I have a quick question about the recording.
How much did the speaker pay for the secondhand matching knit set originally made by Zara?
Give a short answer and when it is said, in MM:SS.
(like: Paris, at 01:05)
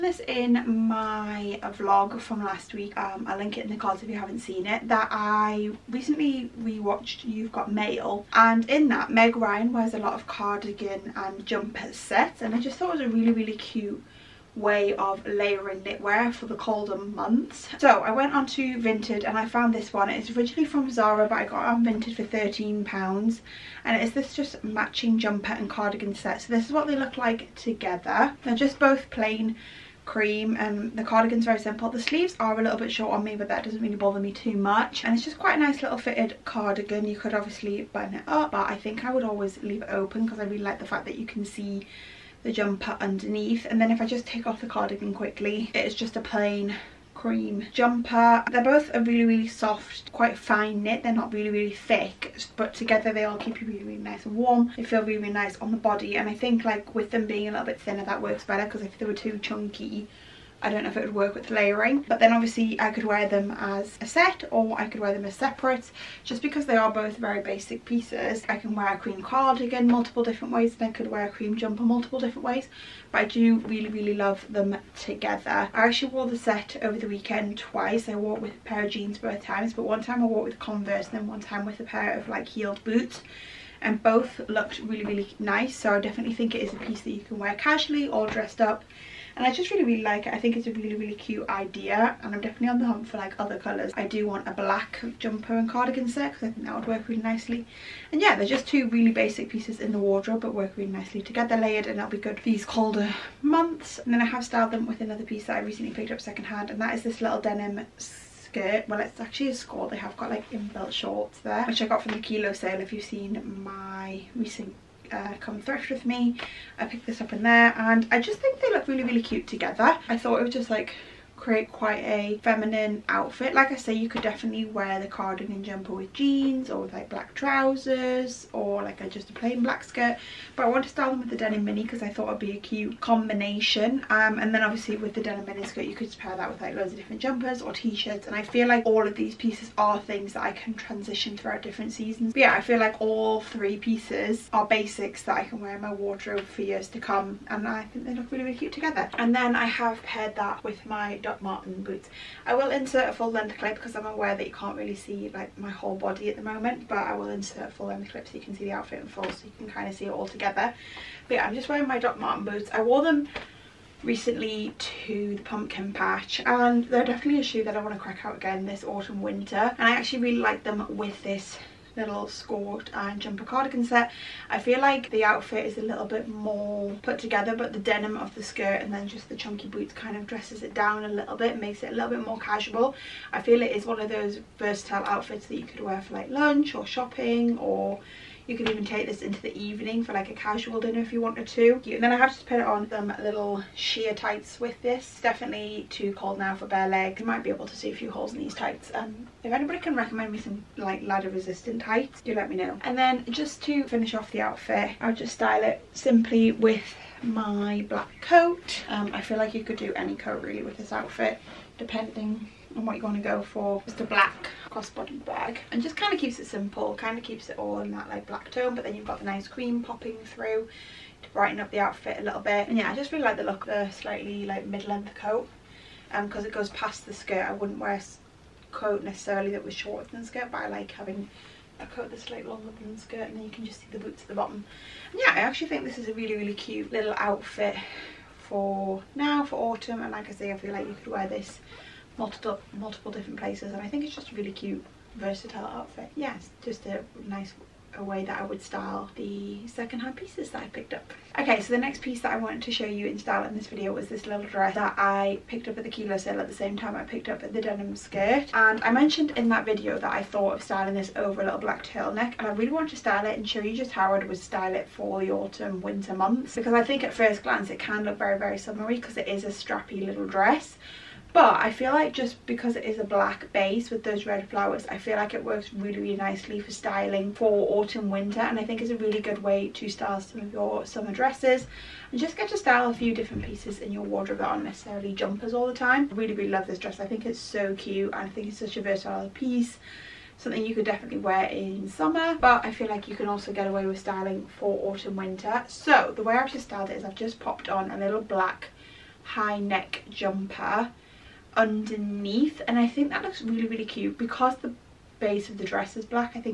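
£13, at 00:22.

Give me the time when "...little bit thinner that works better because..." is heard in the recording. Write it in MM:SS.
00:57.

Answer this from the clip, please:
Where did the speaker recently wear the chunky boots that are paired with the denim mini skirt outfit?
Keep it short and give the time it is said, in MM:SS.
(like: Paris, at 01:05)
the pumpkin patch, at 02:45.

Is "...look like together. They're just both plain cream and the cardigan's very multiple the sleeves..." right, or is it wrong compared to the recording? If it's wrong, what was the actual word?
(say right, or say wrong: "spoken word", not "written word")
wrong: "simple", not "multiple".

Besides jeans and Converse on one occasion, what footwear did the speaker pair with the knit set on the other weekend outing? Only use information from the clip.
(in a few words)
heeled boots.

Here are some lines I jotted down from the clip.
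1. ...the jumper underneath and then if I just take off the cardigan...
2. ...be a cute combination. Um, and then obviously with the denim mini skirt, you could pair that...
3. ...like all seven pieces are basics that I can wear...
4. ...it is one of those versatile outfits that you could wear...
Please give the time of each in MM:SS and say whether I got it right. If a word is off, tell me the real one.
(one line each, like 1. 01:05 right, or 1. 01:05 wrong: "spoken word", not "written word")
1. 00:42 right
2. 02:12 right
3. 02:22 wrong: "three", not "seven"
4. 03:03 right.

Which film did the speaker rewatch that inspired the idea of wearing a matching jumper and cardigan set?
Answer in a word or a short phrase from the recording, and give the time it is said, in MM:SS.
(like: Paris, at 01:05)
You've Got Mail, at 00:07.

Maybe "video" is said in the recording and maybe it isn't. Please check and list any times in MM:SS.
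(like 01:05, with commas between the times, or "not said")
04:13, 04:19.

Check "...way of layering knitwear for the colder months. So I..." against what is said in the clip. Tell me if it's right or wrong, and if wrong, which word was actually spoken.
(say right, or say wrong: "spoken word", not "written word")
right.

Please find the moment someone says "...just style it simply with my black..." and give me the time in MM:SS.
03:25.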